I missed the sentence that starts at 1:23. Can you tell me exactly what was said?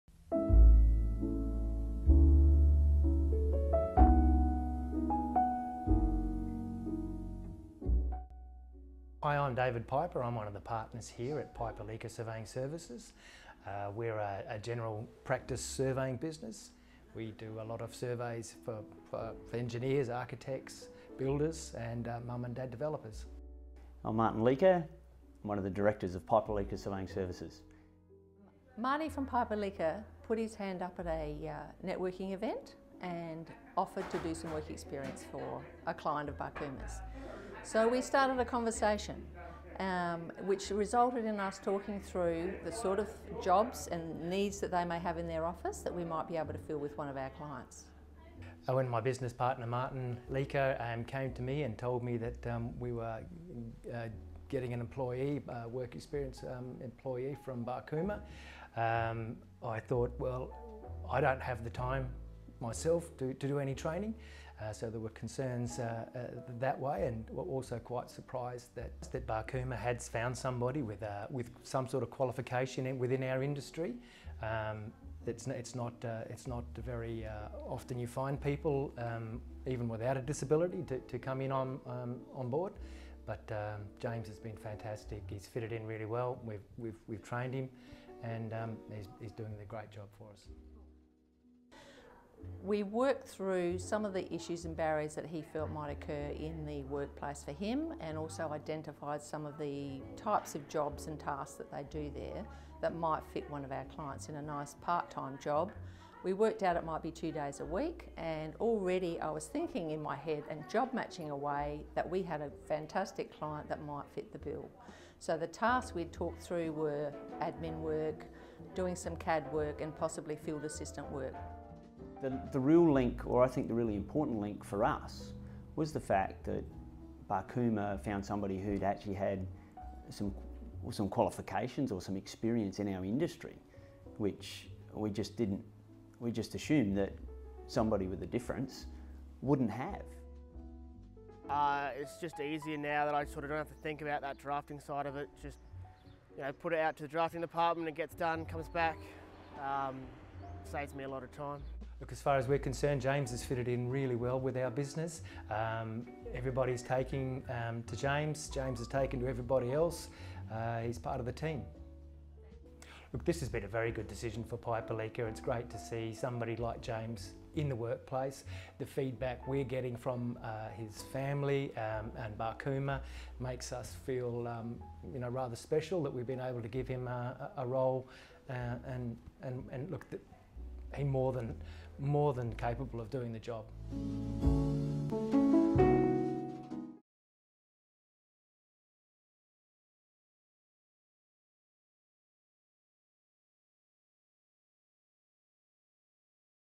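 But um, James has been fantastic.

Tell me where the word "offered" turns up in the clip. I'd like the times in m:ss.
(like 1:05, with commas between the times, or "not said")
0:33.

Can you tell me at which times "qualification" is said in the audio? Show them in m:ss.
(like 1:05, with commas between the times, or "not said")
1:12, 2:11.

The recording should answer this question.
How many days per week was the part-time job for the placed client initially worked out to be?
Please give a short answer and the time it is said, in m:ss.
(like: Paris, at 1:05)
2, at 1:47.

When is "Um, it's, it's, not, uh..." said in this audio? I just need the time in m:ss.
1:14.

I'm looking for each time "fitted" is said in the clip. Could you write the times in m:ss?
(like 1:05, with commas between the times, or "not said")
1:25, 2:33.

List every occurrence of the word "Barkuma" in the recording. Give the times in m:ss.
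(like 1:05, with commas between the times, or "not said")
0:36, 0:57, 1:09, 2:07, 2:52.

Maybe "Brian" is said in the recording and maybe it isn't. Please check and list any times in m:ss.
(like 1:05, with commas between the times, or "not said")
not said.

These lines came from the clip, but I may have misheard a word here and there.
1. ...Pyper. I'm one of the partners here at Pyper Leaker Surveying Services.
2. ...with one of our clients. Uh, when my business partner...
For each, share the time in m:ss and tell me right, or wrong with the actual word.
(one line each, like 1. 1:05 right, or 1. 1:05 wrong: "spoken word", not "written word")
1. 0:09 right
2. 0:46 right.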